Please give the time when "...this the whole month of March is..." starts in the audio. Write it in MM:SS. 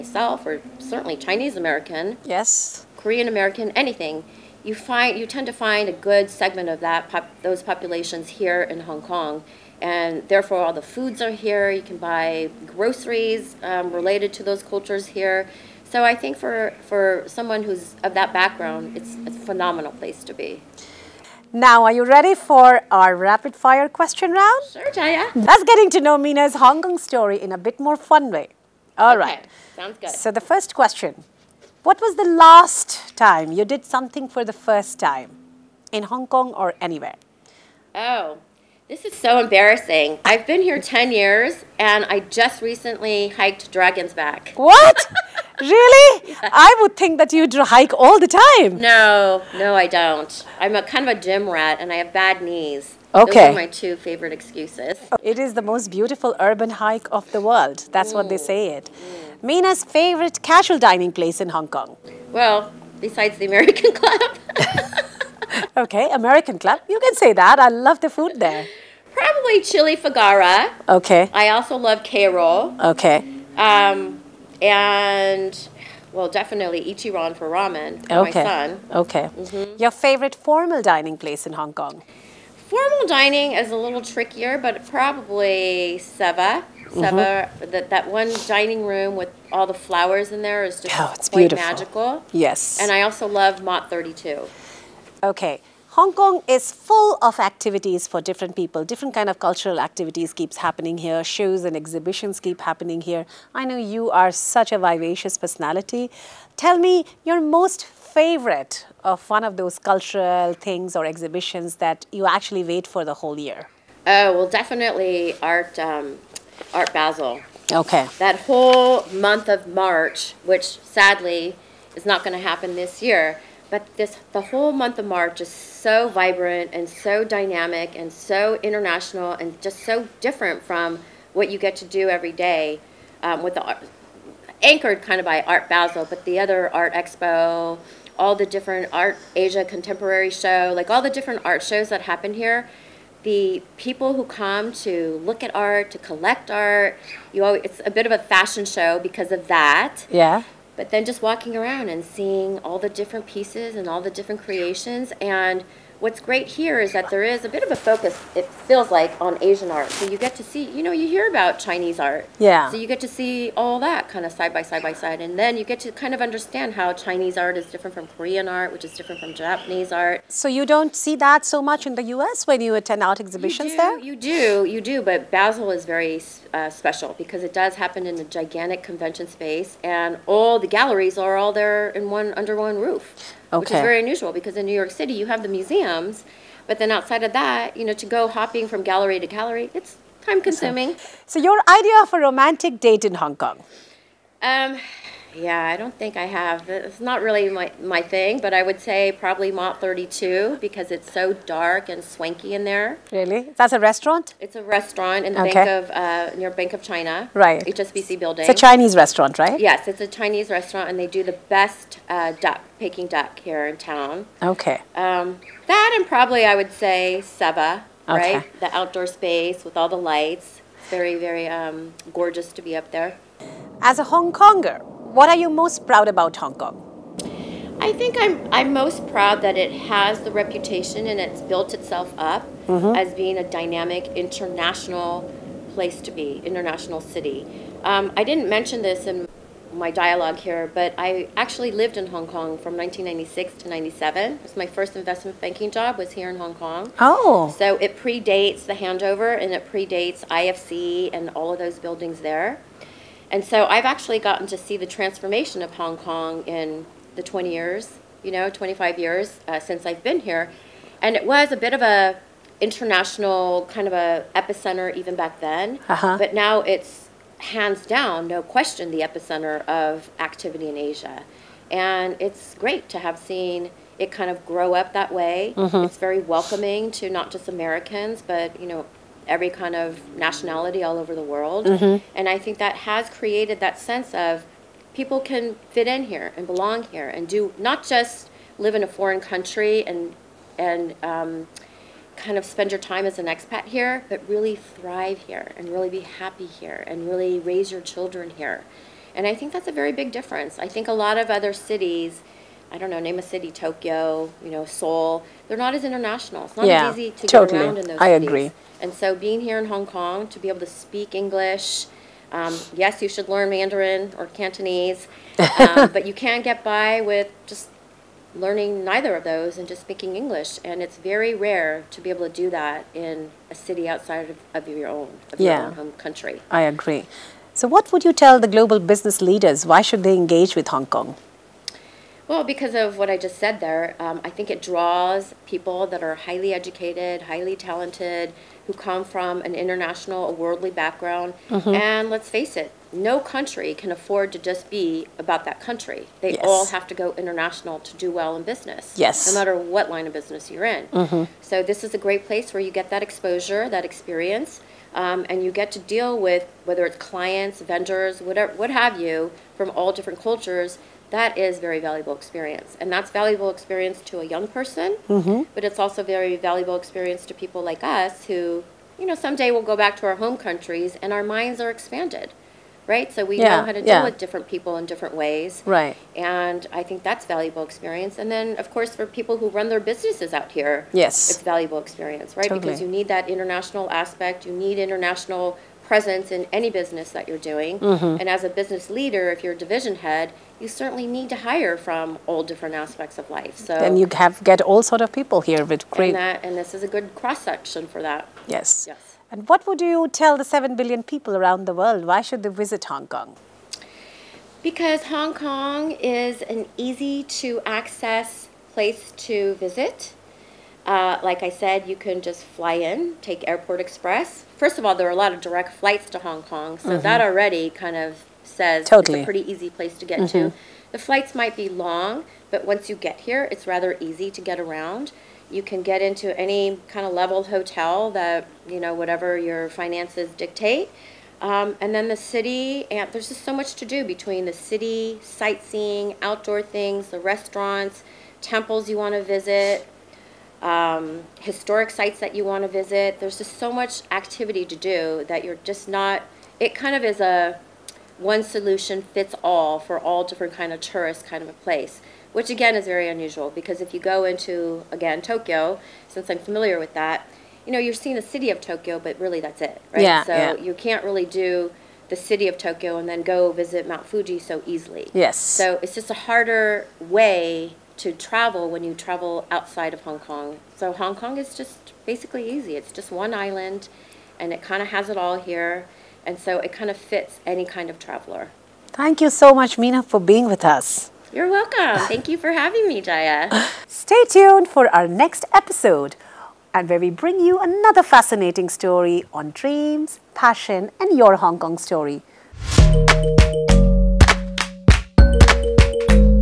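02:03.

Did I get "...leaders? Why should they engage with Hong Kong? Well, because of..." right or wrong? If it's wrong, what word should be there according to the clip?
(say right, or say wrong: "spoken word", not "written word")
right.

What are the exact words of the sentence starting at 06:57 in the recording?
that already kind of says totally.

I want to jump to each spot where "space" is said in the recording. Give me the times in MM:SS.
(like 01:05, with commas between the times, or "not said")
02:59, 03:39.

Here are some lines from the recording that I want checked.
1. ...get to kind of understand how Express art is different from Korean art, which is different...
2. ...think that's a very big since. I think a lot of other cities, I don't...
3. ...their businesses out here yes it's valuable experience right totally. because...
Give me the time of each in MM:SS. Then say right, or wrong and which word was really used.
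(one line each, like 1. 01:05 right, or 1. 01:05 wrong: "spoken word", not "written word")
1. 02:45 wrong: "Chinese", not "Express"
2. 04:59 wrong: "difference", not "since"
3. 06:19 right.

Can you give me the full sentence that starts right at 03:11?
So, your idea of a romantic date in Hong Kong?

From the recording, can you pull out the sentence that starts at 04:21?
And it was a bit of a international kind of a epicenter even back then.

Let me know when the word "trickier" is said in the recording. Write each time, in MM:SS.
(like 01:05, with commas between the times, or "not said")
01:24.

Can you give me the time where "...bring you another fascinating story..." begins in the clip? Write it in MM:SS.
08:07.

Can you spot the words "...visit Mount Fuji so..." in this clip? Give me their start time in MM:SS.
07:43.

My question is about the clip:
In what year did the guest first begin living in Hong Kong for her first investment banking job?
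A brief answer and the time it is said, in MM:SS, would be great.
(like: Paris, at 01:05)
1996, at 04:02.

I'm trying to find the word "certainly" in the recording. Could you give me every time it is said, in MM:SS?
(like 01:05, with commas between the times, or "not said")
00:00, 06:30.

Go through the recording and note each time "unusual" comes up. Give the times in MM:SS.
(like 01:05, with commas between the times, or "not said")
03:03, 07:33.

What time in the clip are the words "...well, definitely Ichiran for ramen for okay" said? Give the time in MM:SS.
01:16.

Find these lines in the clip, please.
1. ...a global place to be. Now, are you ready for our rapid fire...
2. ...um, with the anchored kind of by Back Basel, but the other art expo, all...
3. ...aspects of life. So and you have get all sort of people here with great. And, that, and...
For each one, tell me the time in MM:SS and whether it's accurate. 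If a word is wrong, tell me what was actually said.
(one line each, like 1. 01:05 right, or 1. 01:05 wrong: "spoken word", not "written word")
1. 00:19 wrong: "phenomenal", not "global"
2. 02:13 wrong: "Art", not "Back"
3. 06:32 right.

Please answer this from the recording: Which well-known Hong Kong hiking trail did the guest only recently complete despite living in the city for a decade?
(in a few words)
Dragon's Back.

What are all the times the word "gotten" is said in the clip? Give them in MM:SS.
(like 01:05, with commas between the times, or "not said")
04:14.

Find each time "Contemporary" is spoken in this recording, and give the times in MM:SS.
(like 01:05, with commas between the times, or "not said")
02:19.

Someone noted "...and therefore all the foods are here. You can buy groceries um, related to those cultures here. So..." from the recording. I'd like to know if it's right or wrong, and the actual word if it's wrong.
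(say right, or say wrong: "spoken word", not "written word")
right.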